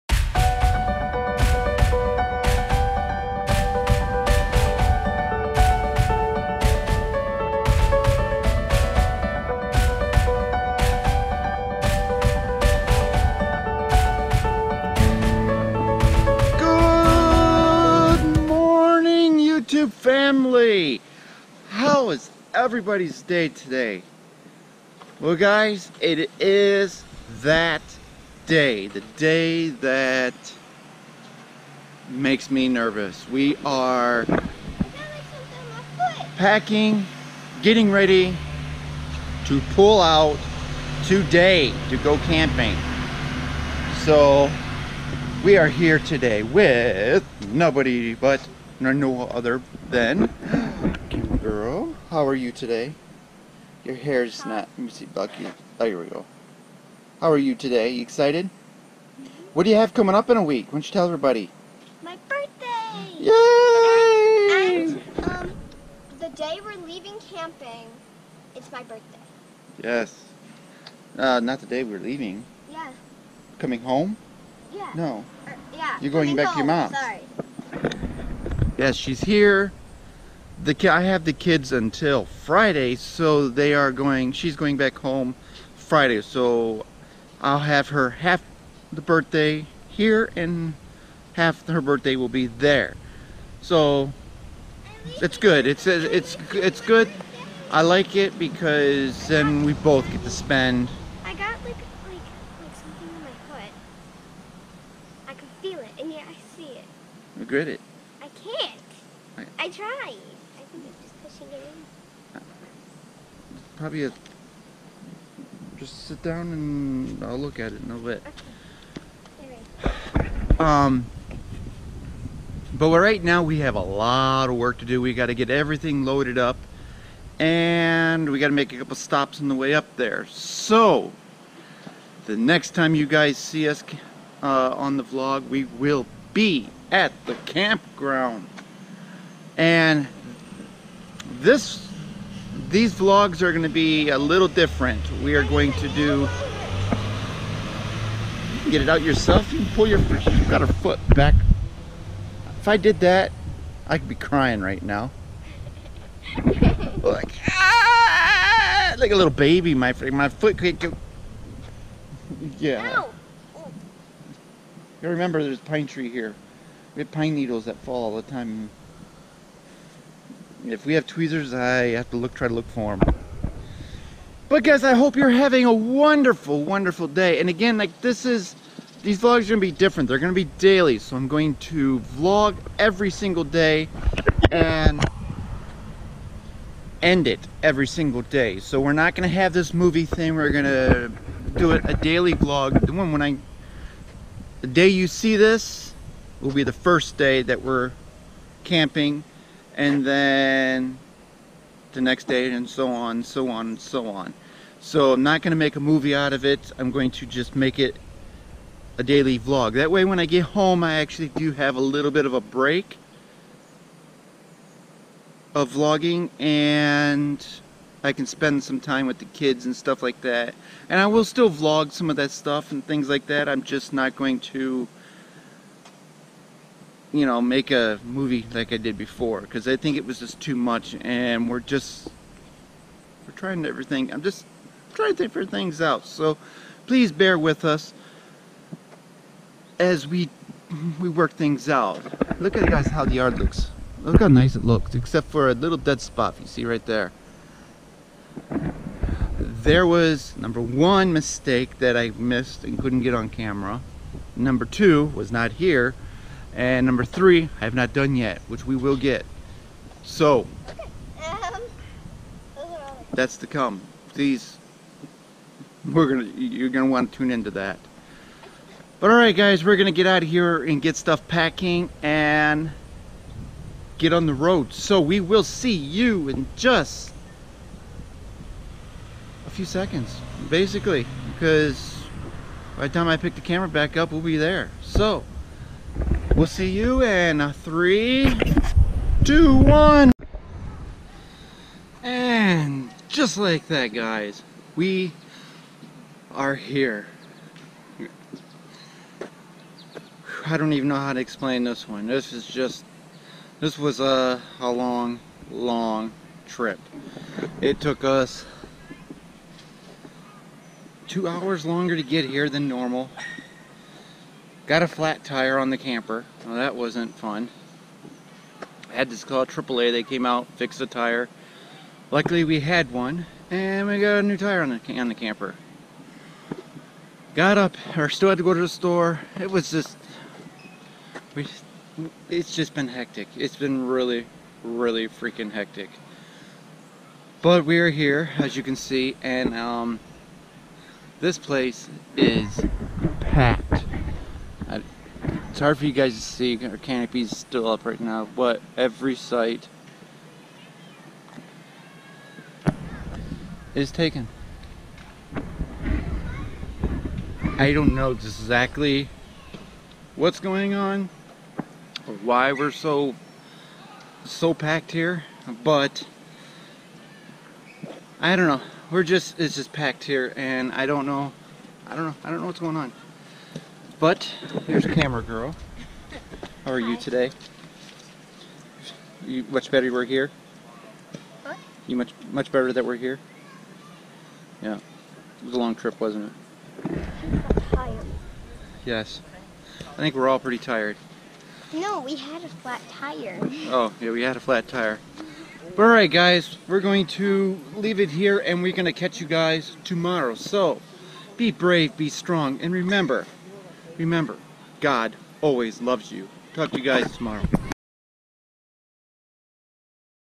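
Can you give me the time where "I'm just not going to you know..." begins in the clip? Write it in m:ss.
3:43.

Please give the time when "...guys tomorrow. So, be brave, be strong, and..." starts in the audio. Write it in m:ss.
6:39.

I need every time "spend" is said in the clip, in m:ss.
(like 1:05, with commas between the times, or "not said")
1:40, 3:38.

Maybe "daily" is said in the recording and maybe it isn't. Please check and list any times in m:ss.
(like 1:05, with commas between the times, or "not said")
3:00, 3:11, 3:29.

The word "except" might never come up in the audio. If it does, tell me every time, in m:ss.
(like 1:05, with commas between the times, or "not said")
4:04.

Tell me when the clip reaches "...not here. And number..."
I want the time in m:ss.
4:15.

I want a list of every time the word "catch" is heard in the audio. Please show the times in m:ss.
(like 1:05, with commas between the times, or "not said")
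6:38.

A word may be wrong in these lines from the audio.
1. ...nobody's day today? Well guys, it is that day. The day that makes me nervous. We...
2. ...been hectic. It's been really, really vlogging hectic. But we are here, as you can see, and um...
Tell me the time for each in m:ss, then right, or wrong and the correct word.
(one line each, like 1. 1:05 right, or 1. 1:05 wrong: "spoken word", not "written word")
1. 0:22 wrong: "everybody", not "nobody"
2. 5:32 wrong: "freaking", not "vlogging".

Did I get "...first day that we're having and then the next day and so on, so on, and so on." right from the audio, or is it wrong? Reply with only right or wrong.
wrong.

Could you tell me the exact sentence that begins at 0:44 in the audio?
So we are here today with nobody but and no other than girl.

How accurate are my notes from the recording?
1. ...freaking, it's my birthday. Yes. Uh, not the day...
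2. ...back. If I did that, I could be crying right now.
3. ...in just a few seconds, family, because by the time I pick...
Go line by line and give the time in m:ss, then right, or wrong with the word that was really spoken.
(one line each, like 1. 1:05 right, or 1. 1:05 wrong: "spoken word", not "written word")
1. 1:07 wrong: "camping", not "freaking"
2. 2:31 right
3. 4:36 wrong: "basically", not "family".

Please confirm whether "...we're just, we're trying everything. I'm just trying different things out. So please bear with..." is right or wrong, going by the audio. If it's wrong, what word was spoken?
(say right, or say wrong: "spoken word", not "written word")
right.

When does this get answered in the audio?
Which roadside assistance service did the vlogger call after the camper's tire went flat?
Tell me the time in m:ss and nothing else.
5:19.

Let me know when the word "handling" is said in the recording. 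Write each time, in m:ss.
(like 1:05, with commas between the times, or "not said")
not said.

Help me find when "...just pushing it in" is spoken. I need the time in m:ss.
1:51.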